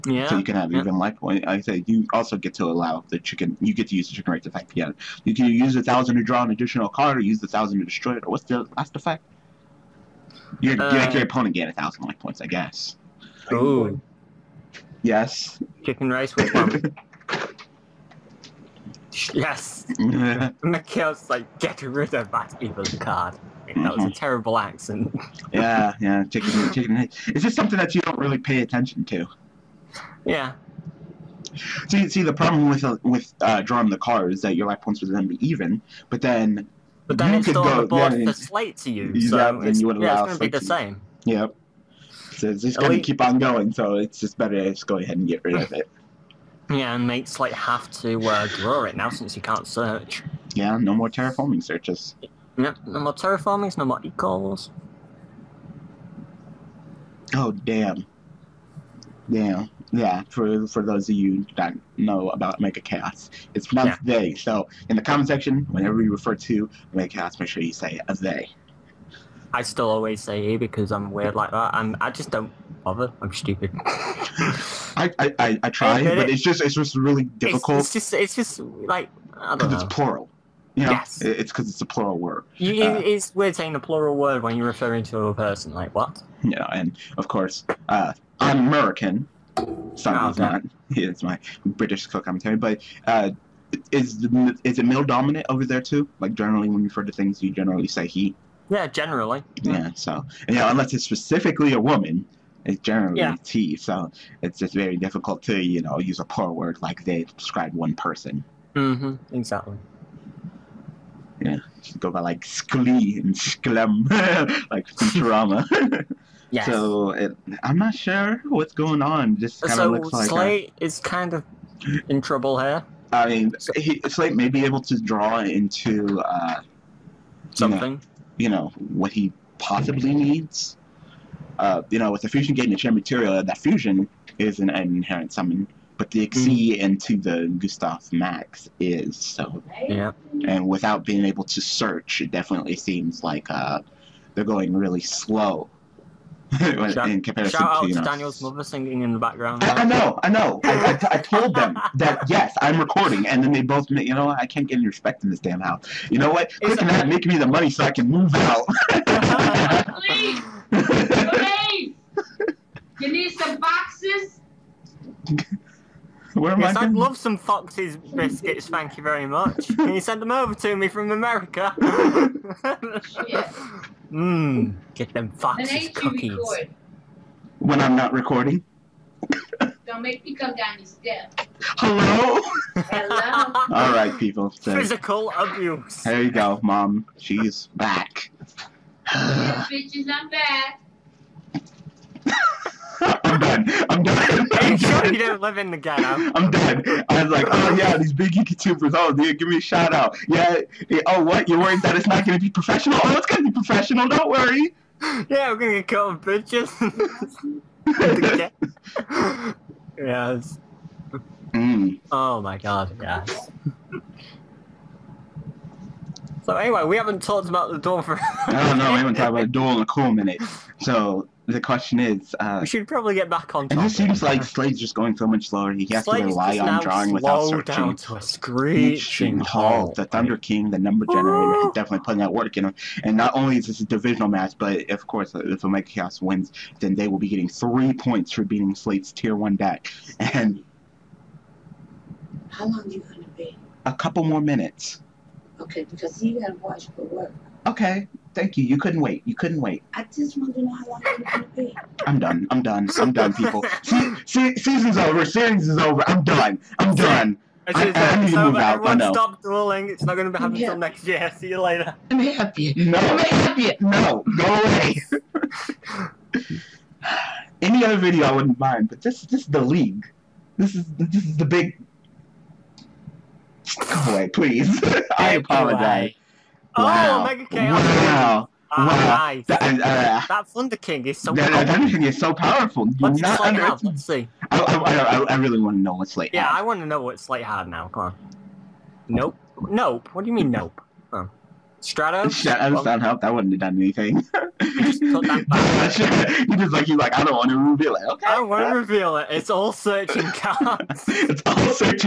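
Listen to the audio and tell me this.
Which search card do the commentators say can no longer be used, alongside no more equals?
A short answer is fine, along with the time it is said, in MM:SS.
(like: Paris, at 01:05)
Terraforming, at 00:53.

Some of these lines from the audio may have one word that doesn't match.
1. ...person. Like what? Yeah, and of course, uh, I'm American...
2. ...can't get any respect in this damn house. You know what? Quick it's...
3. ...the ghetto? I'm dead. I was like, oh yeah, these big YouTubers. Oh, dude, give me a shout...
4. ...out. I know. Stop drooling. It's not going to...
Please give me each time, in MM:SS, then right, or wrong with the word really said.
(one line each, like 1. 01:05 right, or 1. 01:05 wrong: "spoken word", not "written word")
1. 01:25 right
2. 02:34 right
3. 03:15 right
4. 04:18 right.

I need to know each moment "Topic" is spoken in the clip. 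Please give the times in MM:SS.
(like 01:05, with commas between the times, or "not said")
03:43.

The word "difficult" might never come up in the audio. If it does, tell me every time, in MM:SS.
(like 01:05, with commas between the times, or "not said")
01:17, 01:44.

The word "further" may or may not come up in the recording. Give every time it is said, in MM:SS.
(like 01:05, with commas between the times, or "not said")
not said.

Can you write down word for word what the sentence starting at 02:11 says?
Uh, you know, with the fusion gate the chain material, that fusion isn't an inherent summon, but the mm.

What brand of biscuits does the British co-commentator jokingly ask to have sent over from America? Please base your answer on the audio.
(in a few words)
Fox's.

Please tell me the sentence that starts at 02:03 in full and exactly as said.
I mean, he, Slate may be able to draw into uh, something.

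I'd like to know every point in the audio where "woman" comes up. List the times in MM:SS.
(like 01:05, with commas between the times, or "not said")
01:41.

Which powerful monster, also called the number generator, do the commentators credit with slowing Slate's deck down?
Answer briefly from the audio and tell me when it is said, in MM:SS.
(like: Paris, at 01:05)
The Thunder King, at 03:49.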